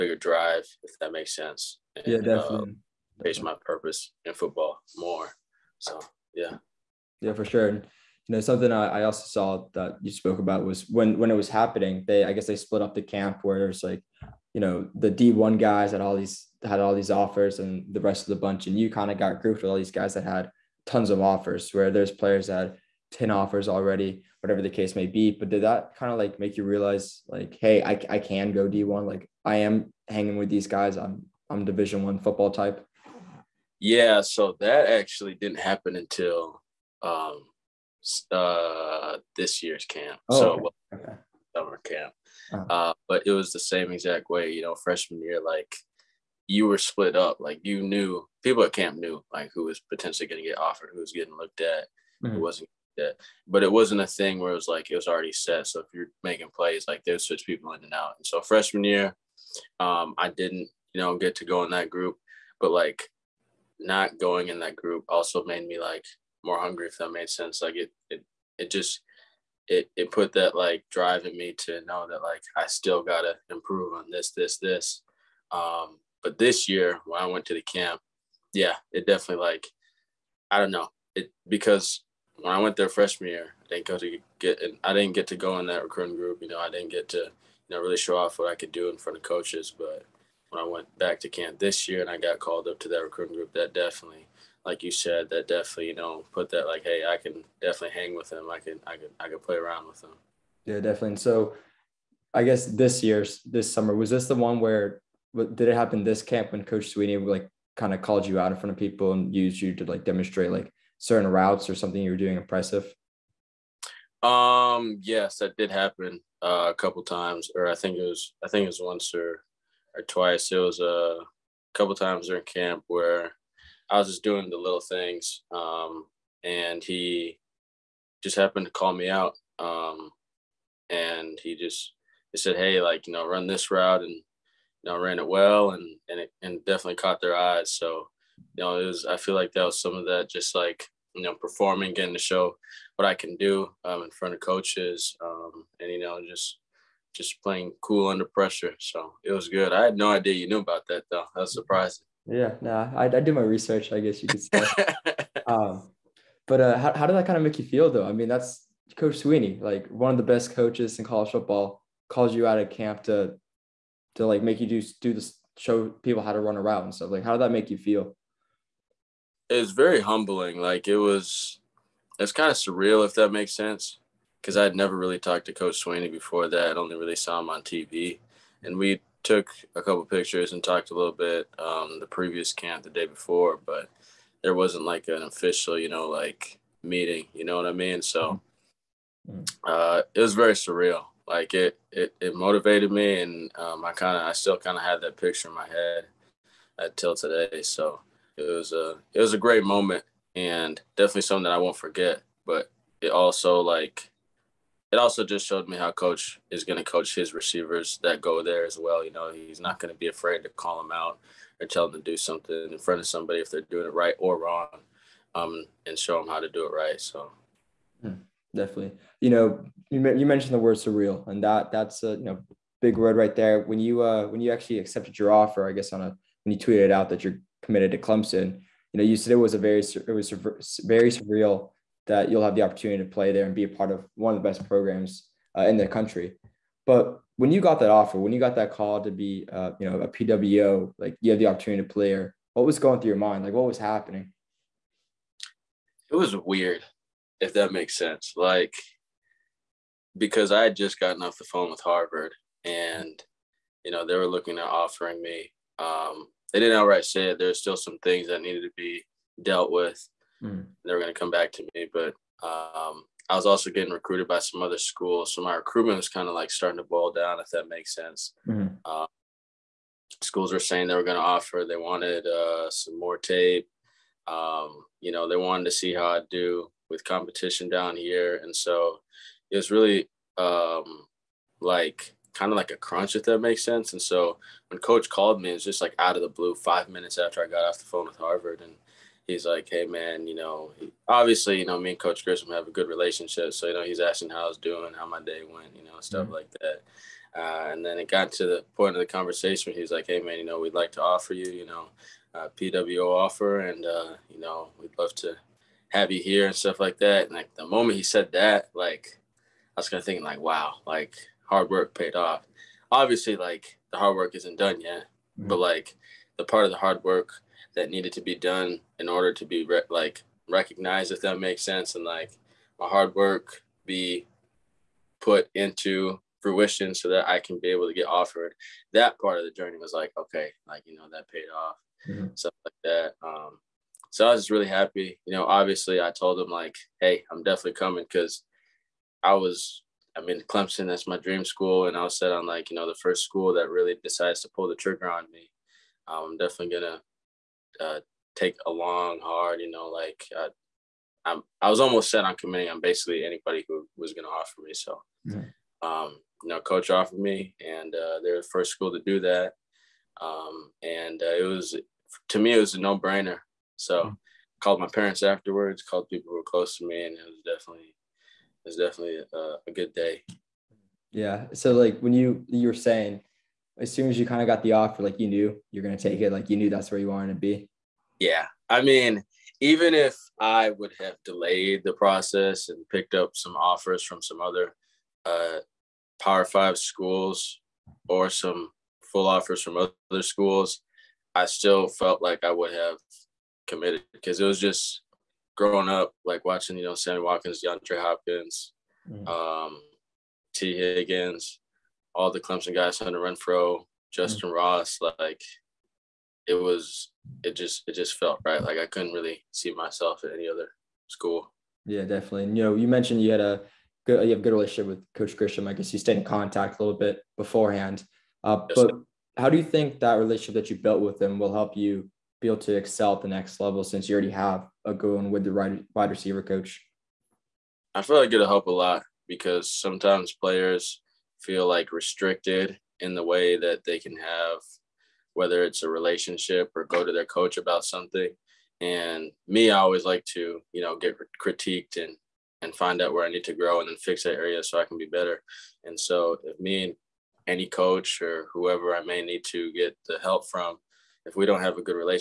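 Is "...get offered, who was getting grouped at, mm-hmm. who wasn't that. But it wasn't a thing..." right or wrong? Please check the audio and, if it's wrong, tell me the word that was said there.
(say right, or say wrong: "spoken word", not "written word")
wrong: "looked", not "grouped".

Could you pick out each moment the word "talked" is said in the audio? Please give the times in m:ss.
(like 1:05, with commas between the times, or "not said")
2:55, 3:00.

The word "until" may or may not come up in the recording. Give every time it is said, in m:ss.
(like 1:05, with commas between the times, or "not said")
0:35, 3:16.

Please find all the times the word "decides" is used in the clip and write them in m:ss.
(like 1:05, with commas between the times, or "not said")
5:44.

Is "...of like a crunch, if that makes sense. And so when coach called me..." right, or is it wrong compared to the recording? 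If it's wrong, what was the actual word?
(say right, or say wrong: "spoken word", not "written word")
right.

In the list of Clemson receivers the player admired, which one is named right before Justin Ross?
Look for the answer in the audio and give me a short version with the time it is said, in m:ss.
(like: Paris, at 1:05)
Hunter Renfrow, at 6:42.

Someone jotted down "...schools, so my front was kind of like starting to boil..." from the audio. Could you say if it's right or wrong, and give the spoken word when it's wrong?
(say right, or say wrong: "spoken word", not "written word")
wrong: "recruitment", not "front".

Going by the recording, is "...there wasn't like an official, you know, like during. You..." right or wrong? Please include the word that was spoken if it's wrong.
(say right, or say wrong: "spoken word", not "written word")
wrong: "meeting", not "during".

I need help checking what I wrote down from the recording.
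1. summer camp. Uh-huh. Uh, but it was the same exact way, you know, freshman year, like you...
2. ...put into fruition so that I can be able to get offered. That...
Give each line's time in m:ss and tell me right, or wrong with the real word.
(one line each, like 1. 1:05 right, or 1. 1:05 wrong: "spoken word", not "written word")
1. 0:41 right
2. 5:25 right.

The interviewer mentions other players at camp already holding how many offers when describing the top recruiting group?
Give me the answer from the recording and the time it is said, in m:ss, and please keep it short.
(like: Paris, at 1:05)
10, at 0:23.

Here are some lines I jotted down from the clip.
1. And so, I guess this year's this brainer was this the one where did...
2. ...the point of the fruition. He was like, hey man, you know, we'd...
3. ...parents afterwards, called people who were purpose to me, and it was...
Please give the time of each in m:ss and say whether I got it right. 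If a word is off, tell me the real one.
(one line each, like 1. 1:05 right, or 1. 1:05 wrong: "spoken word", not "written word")
1. 1:41 wrong: "summer", not "brainer"
2. 4:58 wrong: "conversation", not "fruition"
3. 6:04 wrong: "close", not "purpose".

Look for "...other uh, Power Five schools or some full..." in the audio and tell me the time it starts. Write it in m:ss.
6:24.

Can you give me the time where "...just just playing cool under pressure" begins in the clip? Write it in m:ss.
2:26.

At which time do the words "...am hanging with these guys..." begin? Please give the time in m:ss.
0:29.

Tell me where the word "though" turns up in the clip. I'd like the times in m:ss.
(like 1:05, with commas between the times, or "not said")
2:31, 2:37.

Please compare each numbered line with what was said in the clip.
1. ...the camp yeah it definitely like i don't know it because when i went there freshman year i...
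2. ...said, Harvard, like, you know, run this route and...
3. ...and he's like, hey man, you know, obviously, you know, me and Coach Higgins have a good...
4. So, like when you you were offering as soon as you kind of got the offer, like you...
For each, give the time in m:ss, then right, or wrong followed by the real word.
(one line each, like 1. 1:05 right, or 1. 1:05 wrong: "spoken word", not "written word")
1. 1:17 right
2. 2:12 wrong: "Hey", not "Harvard"
3. 4:48 wrong: "Grisham", not "Higgins"
4. 6:11 wrong: "saying", not "offering".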